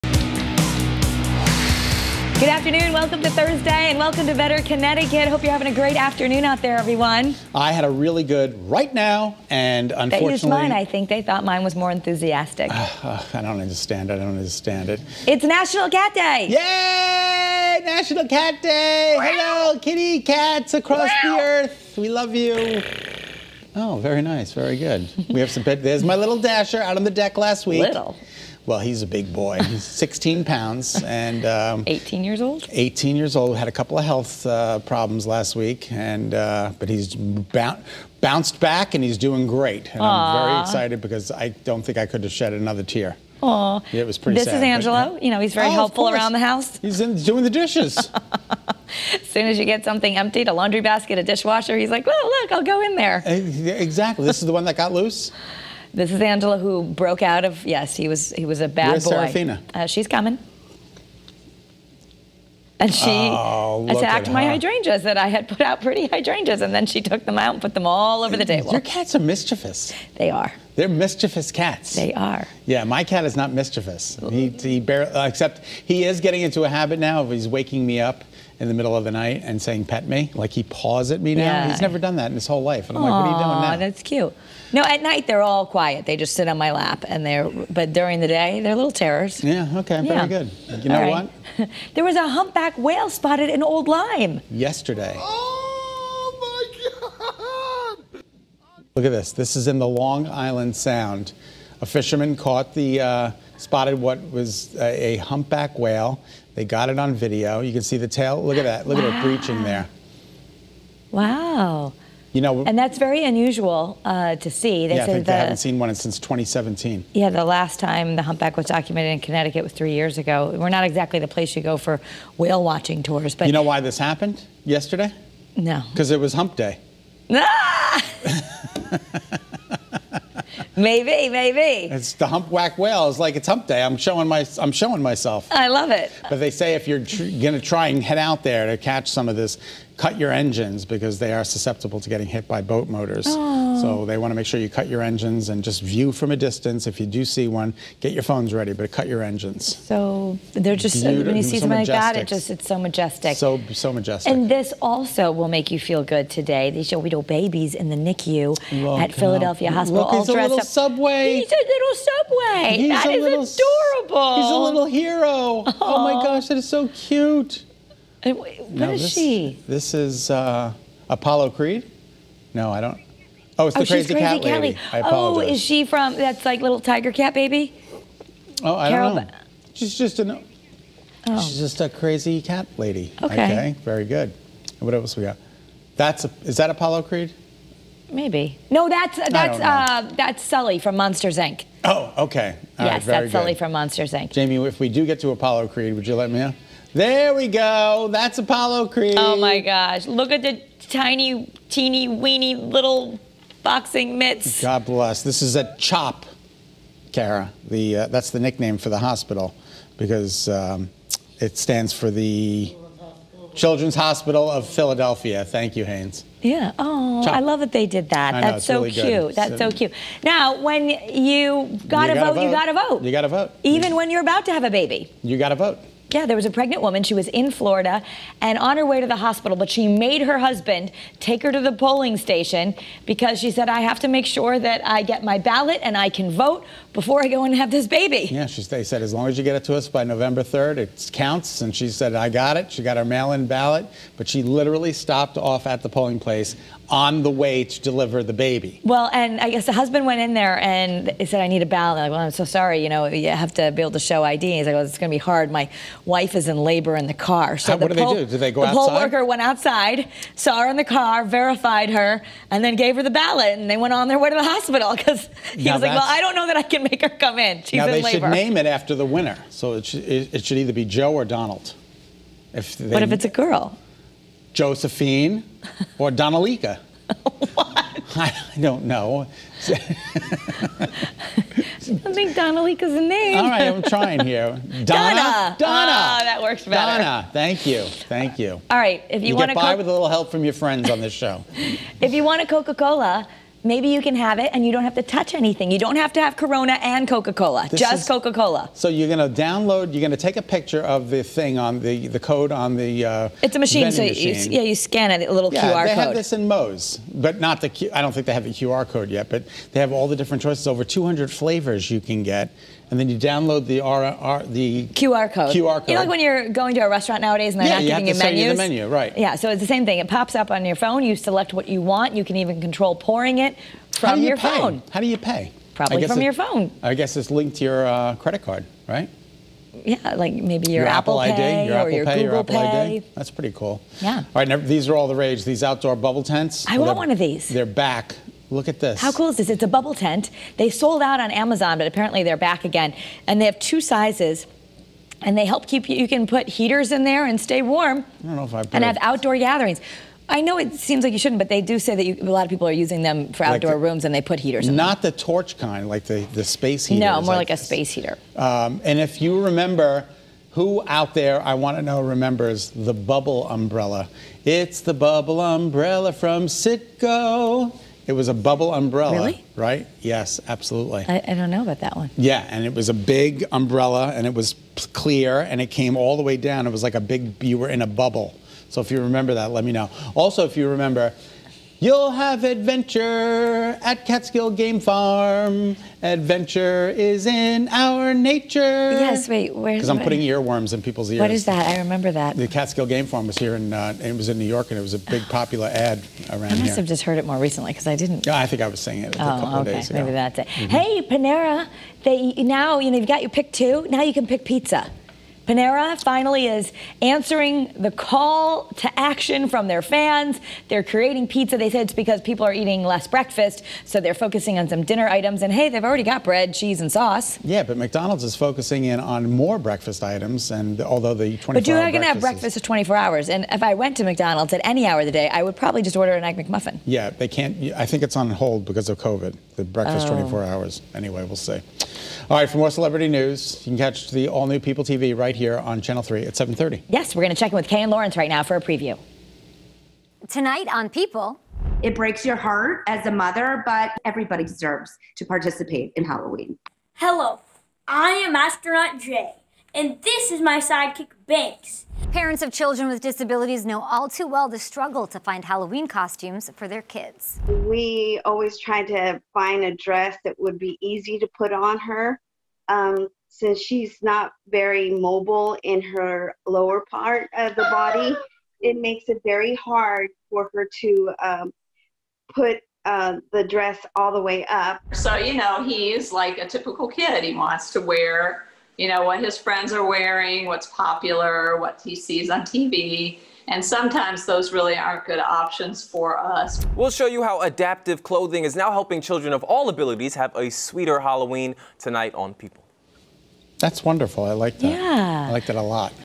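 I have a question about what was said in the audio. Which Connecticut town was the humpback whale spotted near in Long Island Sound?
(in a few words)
Old Lyme.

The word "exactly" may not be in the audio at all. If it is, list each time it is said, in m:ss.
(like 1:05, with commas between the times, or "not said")
0:53, 2:00.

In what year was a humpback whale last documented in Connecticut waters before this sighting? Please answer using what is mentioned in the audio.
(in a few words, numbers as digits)
2017.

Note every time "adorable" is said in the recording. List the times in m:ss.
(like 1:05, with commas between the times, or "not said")
2:43.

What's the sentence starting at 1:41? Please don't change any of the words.
A fisherman caught the, uh, spotted what was a, a, humpback whale.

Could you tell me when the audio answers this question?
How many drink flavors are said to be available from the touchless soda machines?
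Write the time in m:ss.
5:10.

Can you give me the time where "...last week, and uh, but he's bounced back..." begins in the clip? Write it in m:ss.
0:35.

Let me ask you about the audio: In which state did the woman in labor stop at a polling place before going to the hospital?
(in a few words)
Florida.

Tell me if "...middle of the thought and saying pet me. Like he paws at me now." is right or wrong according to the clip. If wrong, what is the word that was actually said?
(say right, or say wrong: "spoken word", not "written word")
wrong: "night", not "thought".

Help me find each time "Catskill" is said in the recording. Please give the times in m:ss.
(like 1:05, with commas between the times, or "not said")
6:24, 6:32.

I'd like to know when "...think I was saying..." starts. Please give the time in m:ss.
6:38.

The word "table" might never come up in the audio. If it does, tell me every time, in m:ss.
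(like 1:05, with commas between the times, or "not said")
1:08.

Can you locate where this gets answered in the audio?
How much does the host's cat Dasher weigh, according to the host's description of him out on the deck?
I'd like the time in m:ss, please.
0:29.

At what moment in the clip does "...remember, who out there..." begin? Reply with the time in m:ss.
5:59.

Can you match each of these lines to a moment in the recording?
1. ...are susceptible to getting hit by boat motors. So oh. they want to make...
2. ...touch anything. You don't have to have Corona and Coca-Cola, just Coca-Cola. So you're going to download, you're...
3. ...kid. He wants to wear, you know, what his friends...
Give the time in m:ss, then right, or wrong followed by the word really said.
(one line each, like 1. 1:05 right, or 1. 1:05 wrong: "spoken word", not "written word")
1. 2:21 right
2. 4:55 right
3. 7:56 right.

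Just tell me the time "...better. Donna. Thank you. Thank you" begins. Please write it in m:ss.
4:46.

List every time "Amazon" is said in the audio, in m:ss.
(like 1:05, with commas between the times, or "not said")
5:41.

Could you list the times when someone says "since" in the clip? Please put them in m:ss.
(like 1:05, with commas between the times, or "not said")
1:55, 7:43.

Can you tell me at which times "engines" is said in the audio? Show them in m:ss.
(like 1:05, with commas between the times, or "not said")
2:20, 2:25, 2:29.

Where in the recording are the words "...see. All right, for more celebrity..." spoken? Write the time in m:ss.
7:11.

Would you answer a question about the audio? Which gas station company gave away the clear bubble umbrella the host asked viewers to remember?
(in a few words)
Citgo.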